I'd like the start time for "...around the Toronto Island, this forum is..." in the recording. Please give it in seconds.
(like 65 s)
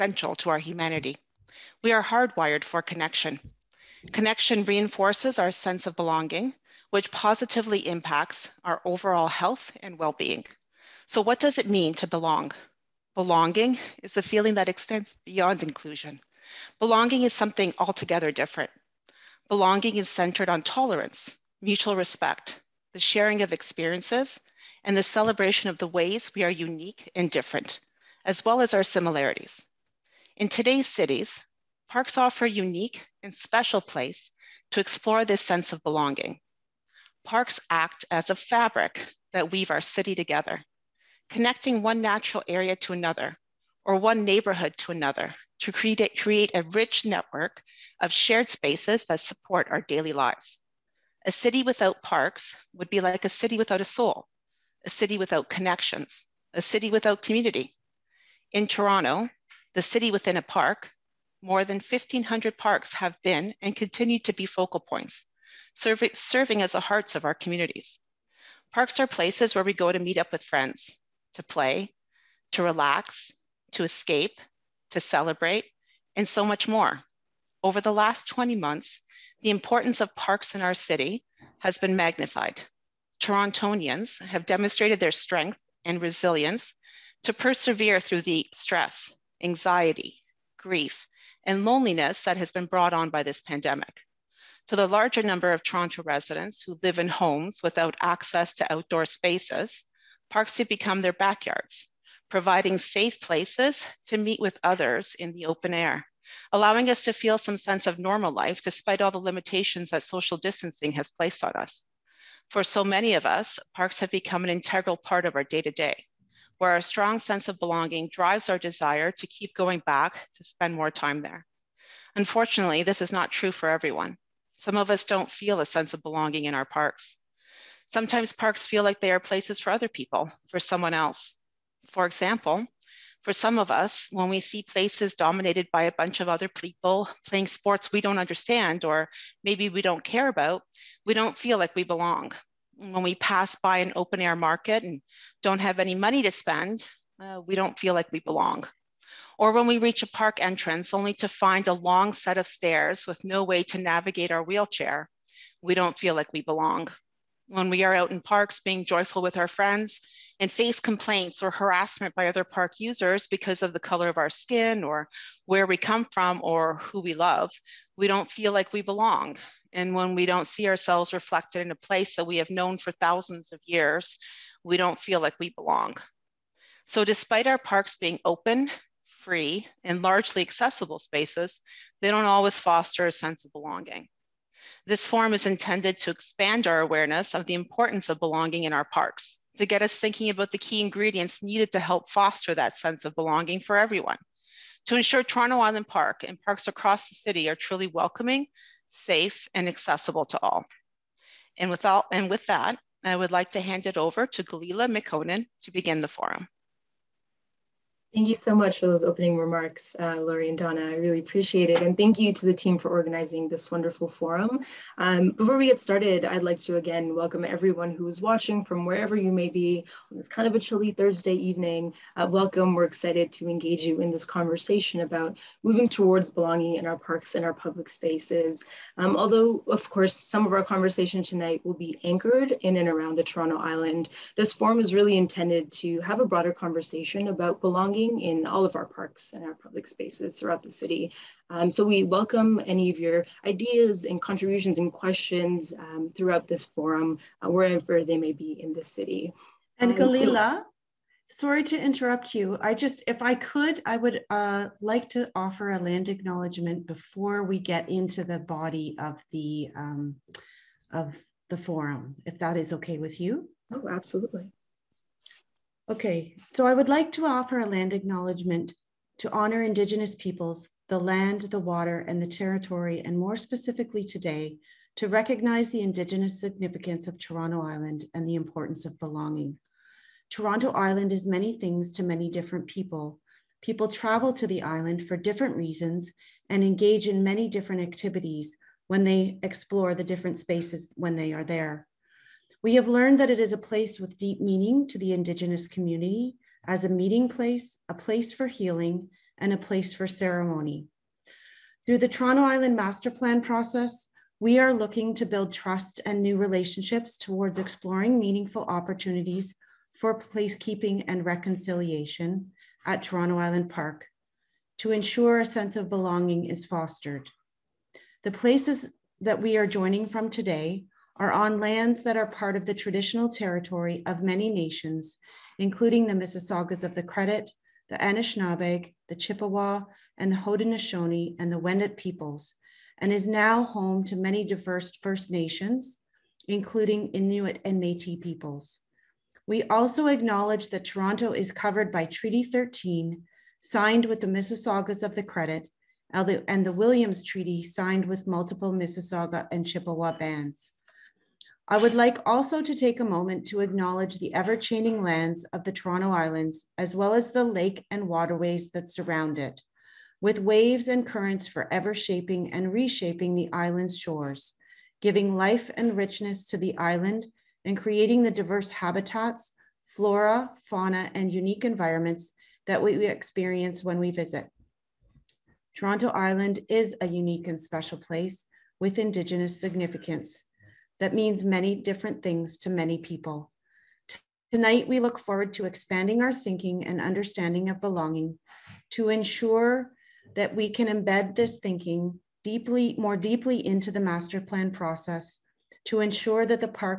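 232 s.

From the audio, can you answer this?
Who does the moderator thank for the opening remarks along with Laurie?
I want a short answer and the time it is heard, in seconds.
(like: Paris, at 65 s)
Donna, at 210 s.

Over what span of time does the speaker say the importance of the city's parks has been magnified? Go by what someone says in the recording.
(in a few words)
20 months.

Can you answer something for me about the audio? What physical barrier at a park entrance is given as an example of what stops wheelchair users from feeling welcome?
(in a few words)
long set of stairs.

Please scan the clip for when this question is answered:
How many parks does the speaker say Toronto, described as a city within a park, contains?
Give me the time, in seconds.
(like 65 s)
61 s.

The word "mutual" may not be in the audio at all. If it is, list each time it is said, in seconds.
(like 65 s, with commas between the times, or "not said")
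21 s.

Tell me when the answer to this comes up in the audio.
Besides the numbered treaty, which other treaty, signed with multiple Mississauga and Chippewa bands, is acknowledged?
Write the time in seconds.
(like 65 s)
346 s.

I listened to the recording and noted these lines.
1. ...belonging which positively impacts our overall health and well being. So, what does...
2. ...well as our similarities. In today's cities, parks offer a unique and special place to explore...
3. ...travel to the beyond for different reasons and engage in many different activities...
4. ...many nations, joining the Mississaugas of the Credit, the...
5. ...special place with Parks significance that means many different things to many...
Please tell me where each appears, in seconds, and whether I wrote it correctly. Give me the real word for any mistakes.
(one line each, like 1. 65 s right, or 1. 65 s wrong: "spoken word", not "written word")
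1. 5 s right
2. 28 s right
3. 283 s wrong: "island", not "beyond"
4. 324 s wrong: "including", not "joining"
5. 377 s wrong: "Indigenous", not "Parks".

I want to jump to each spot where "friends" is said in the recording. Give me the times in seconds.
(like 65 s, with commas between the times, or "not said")
70 s, 159 s.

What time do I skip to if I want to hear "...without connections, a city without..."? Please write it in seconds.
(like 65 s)
55 s.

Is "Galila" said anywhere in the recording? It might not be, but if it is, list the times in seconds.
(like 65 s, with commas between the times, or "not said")
204 s, 249 s.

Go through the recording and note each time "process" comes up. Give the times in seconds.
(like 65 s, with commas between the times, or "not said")
303 s, 394 s.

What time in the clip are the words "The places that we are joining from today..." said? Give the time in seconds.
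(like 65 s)
318 s.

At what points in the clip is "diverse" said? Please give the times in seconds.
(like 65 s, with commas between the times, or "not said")
334 s, 368 s.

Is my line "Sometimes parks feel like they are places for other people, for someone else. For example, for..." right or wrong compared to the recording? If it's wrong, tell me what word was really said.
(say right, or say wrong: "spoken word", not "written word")
right.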